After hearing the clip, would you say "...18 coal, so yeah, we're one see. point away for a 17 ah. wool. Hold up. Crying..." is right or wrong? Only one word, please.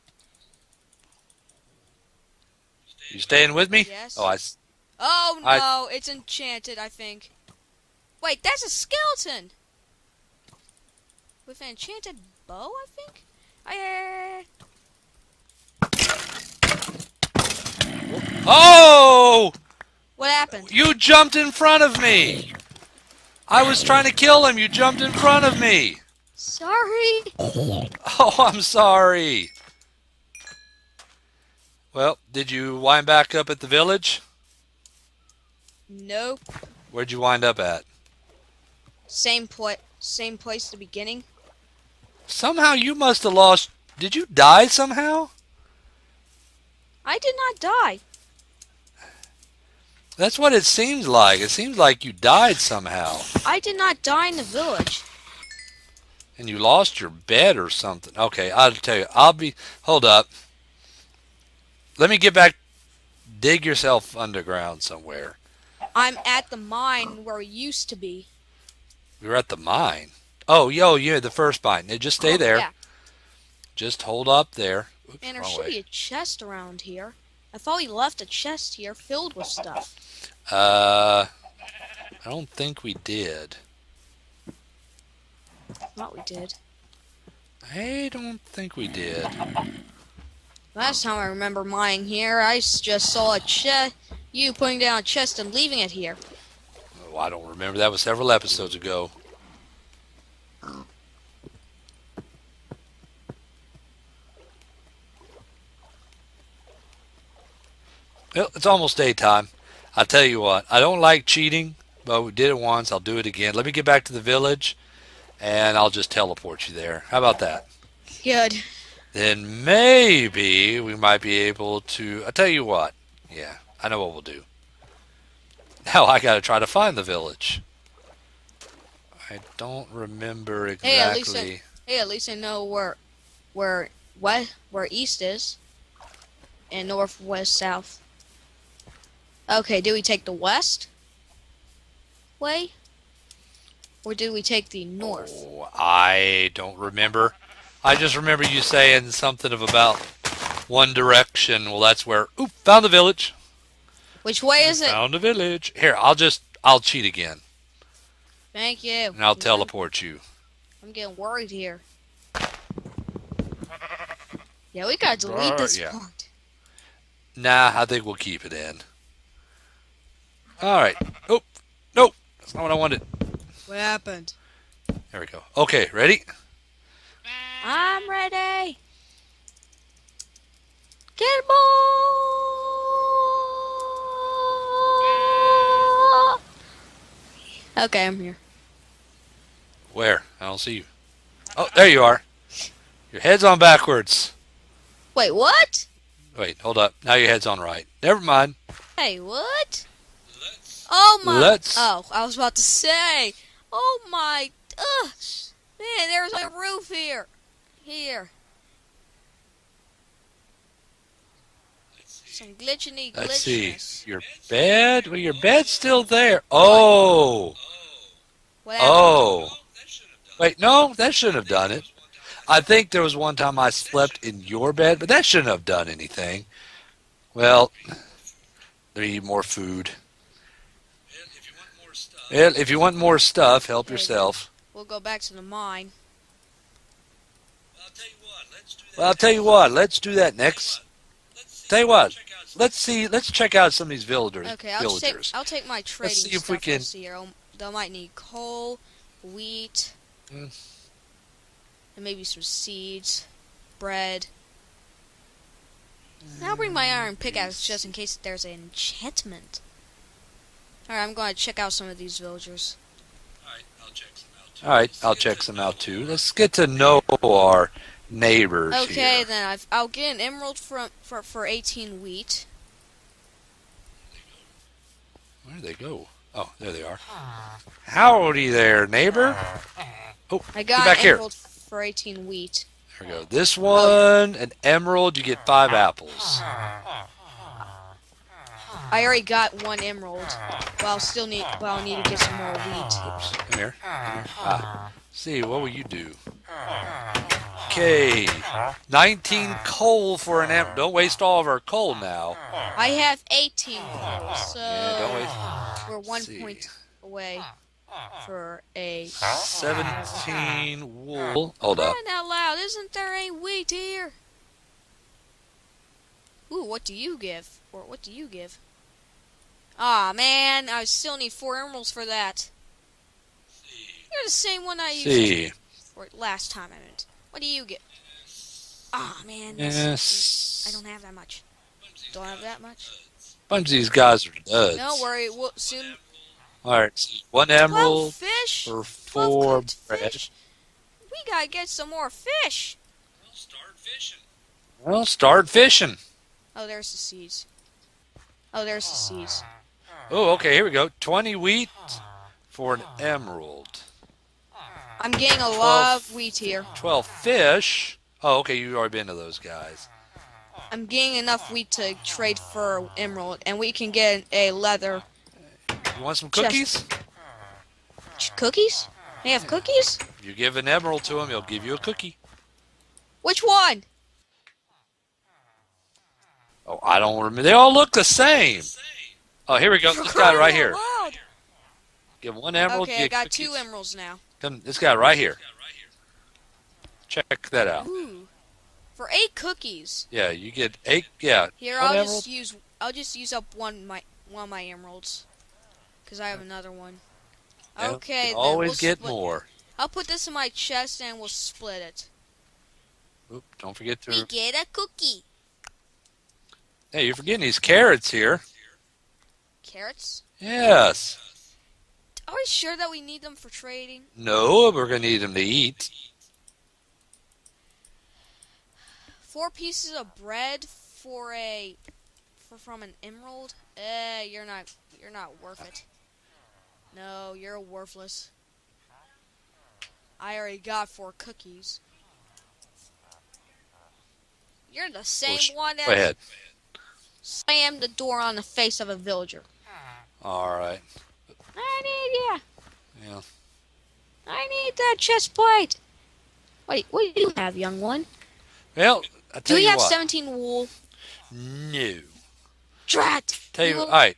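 right.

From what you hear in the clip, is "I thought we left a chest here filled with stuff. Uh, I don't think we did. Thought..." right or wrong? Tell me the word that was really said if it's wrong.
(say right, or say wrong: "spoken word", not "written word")
right.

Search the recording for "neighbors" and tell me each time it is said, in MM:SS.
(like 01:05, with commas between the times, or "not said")
04:28, 04:38.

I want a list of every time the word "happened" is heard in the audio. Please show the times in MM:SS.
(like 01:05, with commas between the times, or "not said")
00:20, 02:53.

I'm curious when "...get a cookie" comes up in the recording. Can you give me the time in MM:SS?
06:44.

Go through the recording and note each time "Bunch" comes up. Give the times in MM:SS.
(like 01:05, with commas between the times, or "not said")
05:33.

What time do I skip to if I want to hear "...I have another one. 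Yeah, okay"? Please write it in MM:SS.
06:36.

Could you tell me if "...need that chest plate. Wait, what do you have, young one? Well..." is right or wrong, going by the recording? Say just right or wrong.
right.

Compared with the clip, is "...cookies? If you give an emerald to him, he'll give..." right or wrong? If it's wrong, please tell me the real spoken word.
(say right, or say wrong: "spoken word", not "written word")
right.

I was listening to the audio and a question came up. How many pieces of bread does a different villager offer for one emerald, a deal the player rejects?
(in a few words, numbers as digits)
4.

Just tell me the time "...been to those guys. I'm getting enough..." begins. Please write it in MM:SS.
05:58.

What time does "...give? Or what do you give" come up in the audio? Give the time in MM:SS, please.
05:17.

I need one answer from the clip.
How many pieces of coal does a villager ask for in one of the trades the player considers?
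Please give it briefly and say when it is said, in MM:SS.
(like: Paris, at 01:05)
19, at 04:58.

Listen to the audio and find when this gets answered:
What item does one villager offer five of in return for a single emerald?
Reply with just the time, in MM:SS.
04:45.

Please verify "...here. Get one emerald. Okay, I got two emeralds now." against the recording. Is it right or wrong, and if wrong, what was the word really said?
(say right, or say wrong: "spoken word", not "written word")
right.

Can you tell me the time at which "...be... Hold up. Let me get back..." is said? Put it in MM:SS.
00:59.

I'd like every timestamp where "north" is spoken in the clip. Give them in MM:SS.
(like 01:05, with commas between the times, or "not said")
02:16, 02:24.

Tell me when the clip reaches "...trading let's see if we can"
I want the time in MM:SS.
04:05.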